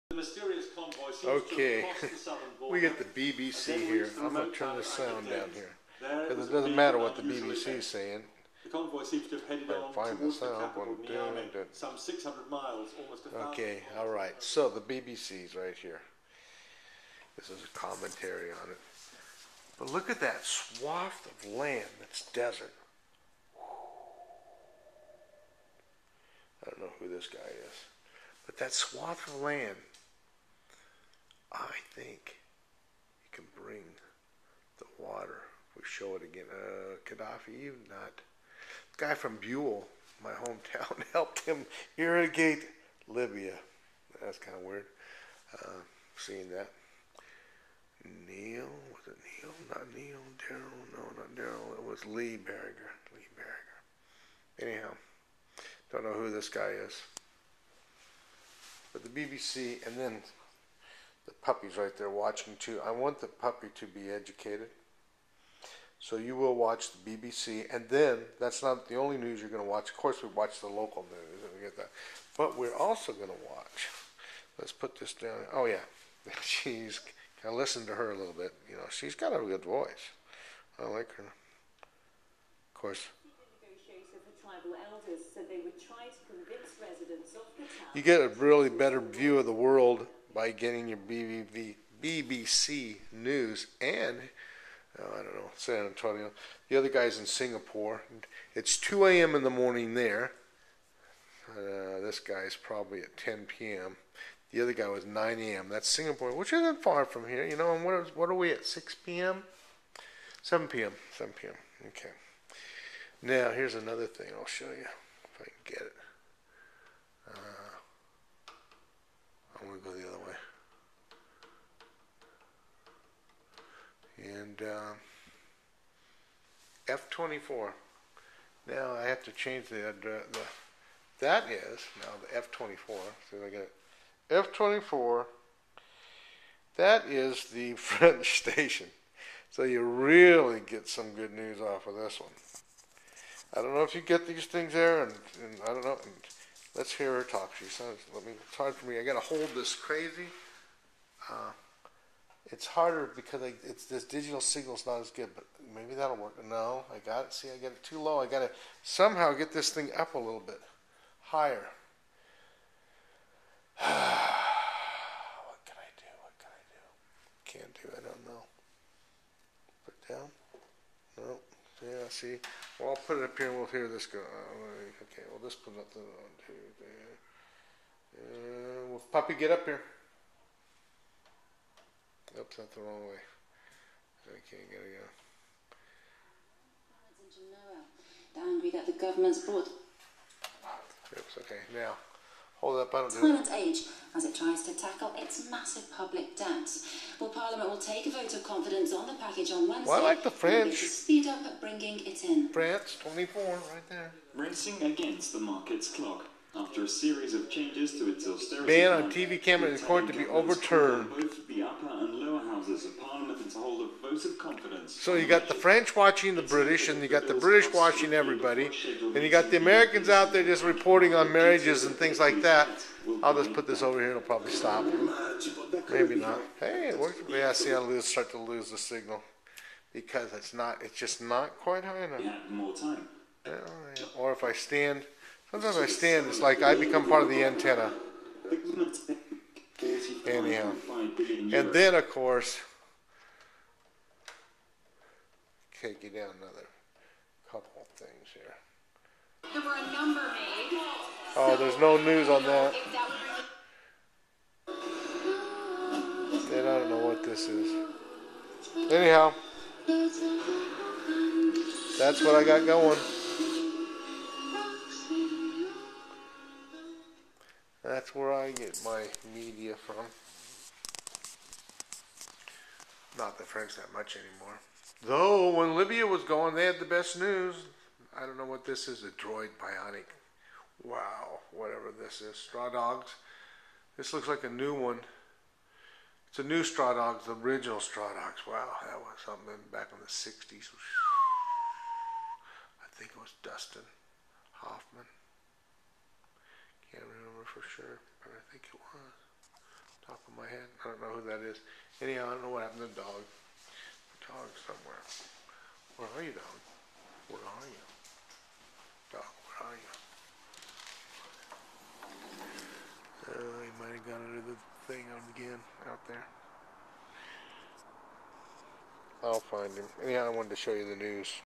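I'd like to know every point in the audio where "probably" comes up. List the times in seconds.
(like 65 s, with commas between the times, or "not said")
102 s, 224 s.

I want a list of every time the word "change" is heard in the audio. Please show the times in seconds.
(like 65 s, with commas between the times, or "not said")
129 s, 207 s.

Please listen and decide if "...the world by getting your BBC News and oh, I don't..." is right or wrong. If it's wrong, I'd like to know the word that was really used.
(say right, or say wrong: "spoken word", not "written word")
right.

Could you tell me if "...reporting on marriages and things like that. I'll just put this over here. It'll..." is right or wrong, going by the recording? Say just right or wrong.
right.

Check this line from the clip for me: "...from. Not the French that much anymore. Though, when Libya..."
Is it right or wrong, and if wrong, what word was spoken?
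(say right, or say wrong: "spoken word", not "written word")
right.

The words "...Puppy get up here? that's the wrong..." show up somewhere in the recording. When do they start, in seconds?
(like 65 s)
179 s.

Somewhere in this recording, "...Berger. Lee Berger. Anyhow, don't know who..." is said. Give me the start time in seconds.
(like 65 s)
52 s.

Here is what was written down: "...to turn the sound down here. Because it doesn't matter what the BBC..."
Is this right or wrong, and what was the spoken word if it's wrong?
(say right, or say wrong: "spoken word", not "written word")
right.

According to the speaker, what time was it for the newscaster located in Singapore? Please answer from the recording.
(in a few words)
2 a.m.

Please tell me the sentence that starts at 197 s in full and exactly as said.
Well, Parliament will take a vote of confidence on the package on Wednesday.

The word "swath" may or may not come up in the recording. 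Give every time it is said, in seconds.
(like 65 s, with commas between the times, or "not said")
20 s, 28 s.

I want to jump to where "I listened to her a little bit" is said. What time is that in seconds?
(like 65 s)
77 s.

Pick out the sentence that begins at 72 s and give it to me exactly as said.
But we're also going to watch.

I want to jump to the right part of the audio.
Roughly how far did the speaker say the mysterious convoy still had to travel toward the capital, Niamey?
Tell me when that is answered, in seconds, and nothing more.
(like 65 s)
11 s.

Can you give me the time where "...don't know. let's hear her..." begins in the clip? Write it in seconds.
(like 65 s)
145 s.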